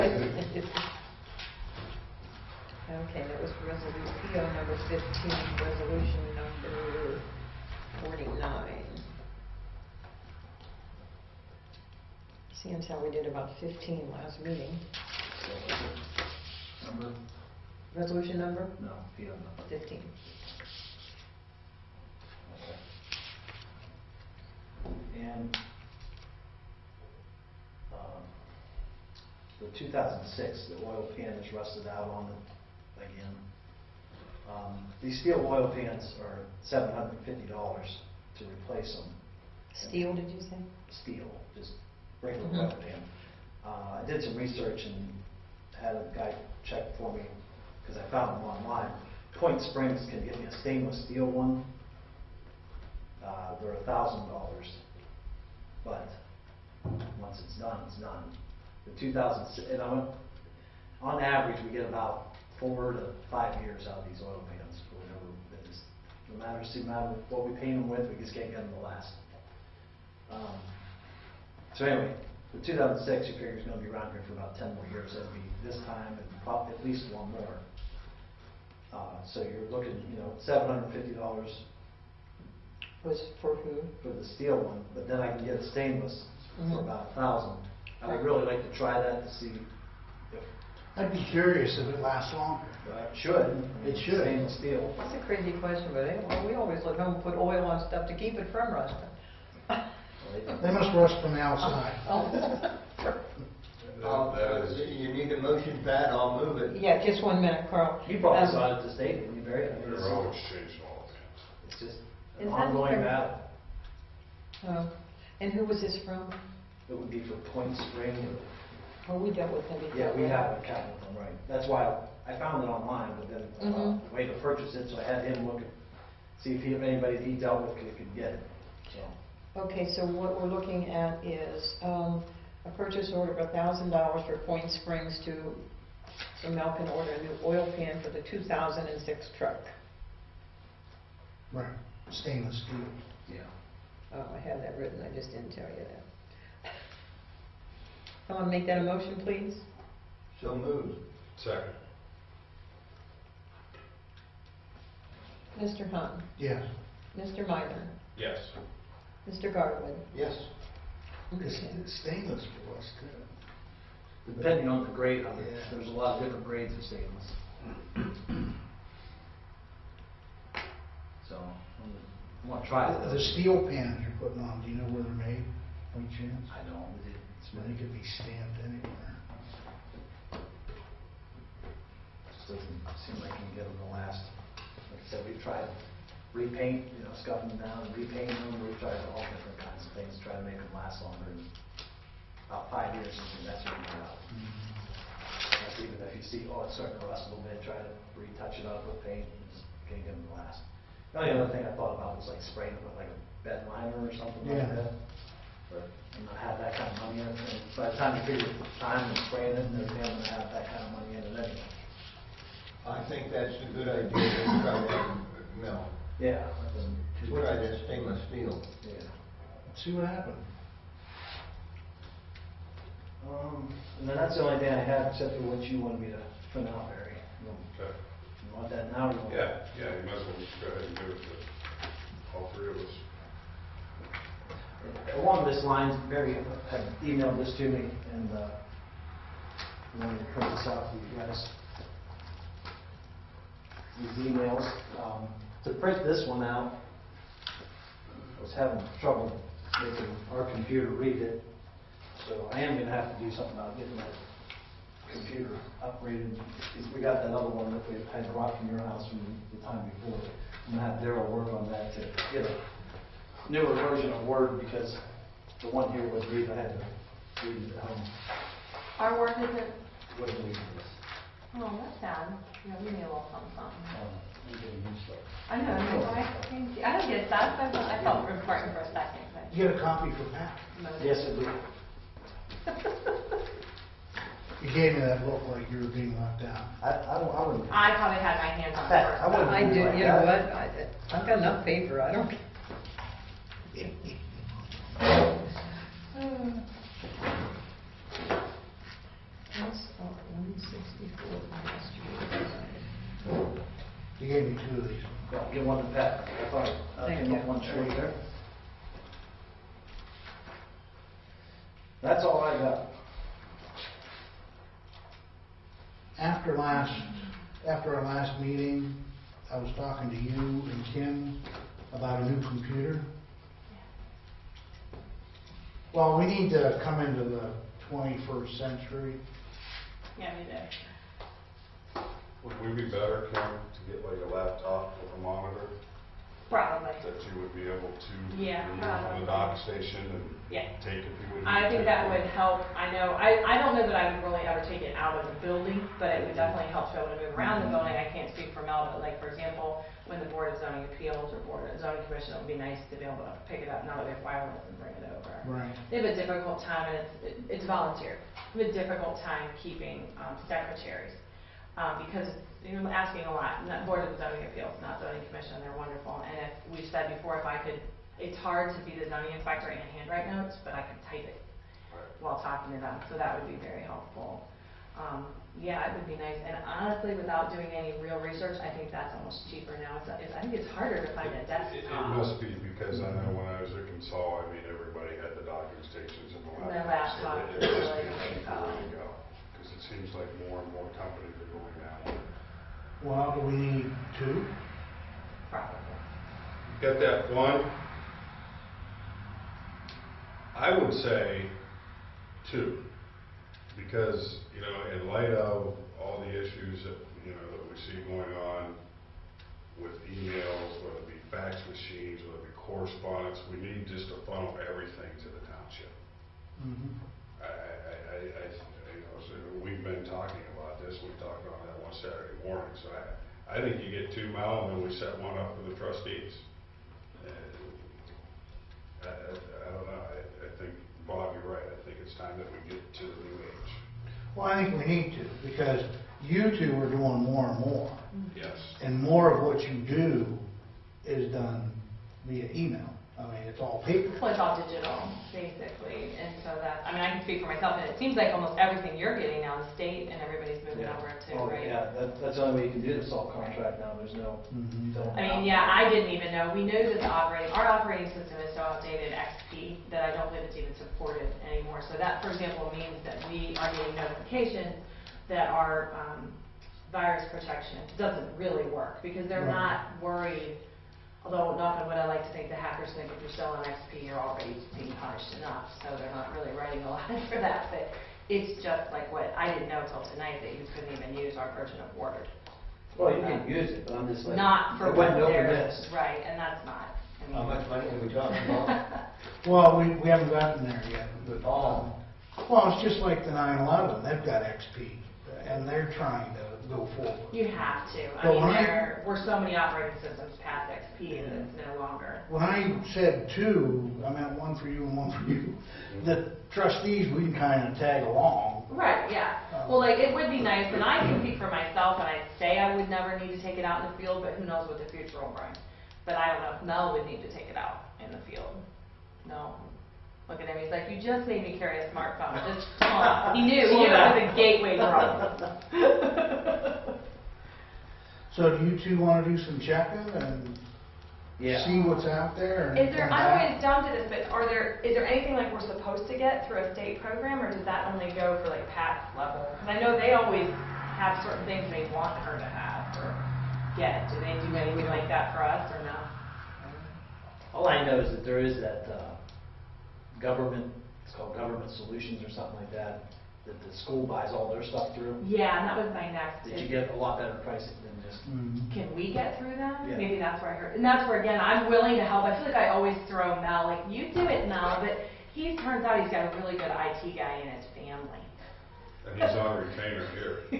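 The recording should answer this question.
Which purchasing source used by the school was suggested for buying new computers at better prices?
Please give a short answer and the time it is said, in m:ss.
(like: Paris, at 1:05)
Government Solutions, at 9:11.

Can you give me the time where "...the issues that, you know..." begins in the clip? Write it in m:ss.
6:46.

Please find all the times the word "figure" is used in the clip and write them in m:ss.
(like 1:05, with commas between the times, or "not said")
1:13, 3:28.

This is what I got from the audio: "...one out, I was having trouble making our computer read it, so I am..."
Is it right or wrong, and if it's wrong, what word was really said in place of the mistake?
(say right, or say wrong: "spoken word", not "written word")
right.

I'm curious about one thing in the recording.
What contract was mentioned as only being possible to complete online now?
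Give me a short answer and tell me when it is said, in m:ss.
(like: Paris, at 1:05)
salt contract, at 7:33.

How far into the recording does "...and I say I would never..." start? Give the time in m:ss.
8:31.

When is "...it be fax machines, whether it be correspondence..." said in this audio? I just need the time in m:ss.
6:51.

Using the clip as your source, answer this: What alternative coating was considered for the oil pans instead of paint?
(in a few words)
bed liner.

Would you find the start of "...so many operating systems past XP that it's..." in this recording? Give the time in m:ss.
8:19.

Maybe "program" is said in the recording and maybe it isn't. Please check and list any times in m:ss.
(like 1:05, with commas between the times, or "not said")
8:57.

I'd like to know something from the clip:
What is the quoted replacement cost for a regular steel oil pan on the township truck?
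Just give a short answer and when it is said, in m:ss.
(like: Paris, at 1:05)
$750, at 0:36.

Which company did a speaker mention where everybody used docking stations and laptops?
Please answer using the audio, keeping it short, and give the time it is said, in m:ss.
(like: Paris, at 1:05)
Consol, at 6:23.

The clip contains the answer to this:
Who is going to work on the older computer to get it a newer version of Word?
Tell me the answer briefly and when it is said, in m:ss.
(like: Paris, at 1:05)
Daryl, at 4:21.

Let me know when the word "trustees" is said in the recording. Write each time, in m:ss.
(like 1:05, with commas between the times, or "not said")
7:05, 8:26.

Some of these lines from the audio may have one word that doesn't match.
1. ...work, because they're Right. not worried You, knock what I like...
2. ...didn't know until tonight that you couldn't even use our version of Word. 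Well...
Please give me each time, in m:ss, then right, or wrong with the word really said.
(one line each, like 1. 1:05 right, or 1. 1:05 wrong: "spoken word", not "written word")
1. 7:48 wrong: "Although", not "You"
2. 7:59 right.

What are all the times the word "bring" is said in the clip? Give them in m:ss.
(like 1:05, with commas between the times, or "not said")
5:54, 8:35.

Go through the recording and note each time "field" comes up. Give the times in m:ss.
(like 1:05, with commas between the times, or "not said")
8:33, 8:38.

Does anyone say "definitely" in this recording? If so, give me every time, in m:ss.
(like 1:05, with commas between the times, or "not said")
5:46.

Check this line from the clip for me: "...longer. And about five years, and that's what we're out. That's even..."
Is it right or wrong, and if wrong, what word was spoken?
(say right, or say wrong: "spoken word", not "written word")
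right.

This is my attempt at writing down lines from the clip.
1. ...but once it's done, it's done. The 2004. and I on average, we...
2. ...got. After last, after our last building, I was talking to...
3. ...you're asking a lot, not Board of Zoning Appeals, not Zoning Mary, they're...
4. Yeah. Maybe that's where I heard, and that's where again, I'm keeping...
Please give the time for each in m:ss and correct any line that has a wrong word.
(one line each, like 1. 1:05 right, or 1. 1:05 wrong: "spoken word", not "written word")
1. 0:55 wrong: "2000", not "2004"
2. 5:12 wrong: "meeting", not "building"
3. 6:02 wrong: "Commission", not "Mary"
4. 9:19 wrong: "willing", not "keeping".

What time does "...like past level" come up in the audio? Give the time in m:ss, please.
8:58.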